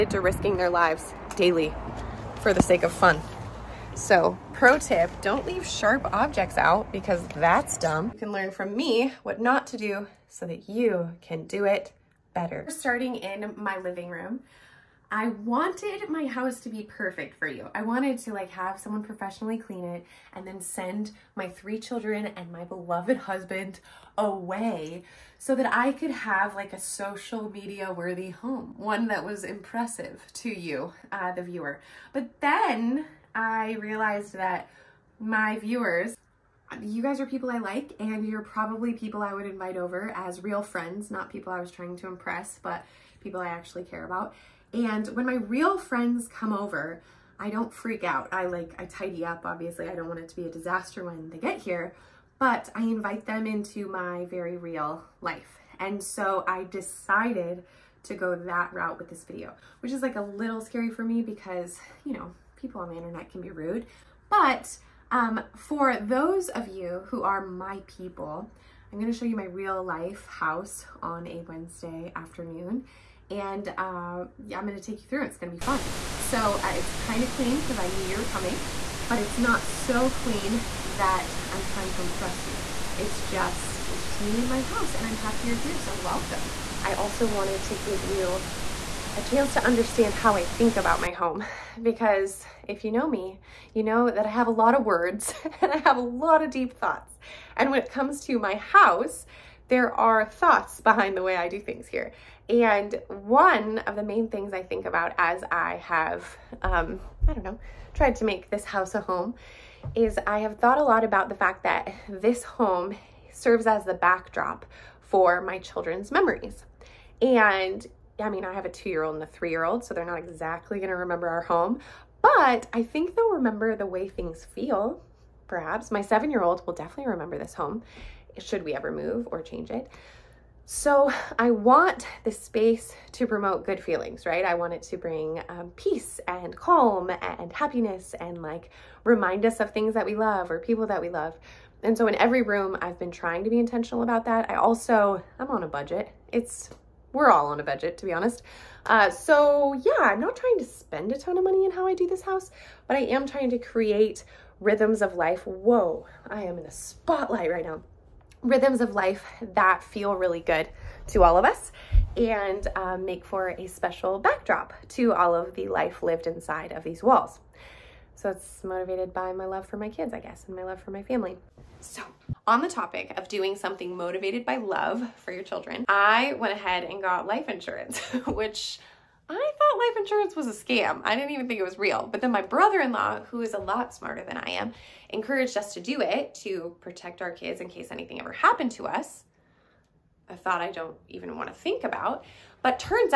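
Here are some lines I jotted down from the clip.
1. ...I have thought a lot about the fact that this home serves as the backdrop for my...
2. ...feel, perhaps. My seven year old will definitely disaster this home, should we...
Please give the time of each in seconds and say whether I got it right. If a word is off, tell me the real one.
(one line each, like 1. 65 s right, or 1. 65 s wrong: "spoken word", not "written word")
1. 110 s right
2. 124 s wrong: "remember", not "disaster".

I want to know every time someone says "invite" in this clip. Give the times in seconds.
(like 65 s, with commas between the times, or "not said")
39 s, 52 s.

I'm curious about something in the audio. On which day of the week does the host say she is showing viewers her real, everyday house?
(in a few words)
Wednesday.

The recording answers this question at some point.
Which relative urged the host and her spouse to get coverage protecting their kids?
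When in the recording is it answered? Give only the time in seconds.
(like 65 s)
182 s.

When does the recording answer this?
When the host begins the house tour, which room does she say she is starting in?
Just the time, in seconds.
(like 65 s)
13 s.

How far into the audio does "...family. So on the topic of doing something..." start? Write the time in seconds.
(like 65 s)
171 s.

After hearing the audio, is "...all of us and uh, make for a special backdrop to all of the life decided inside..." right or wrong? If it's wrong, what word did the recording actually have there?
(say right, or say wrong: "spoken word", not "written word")
wrong: "lived", not "decided".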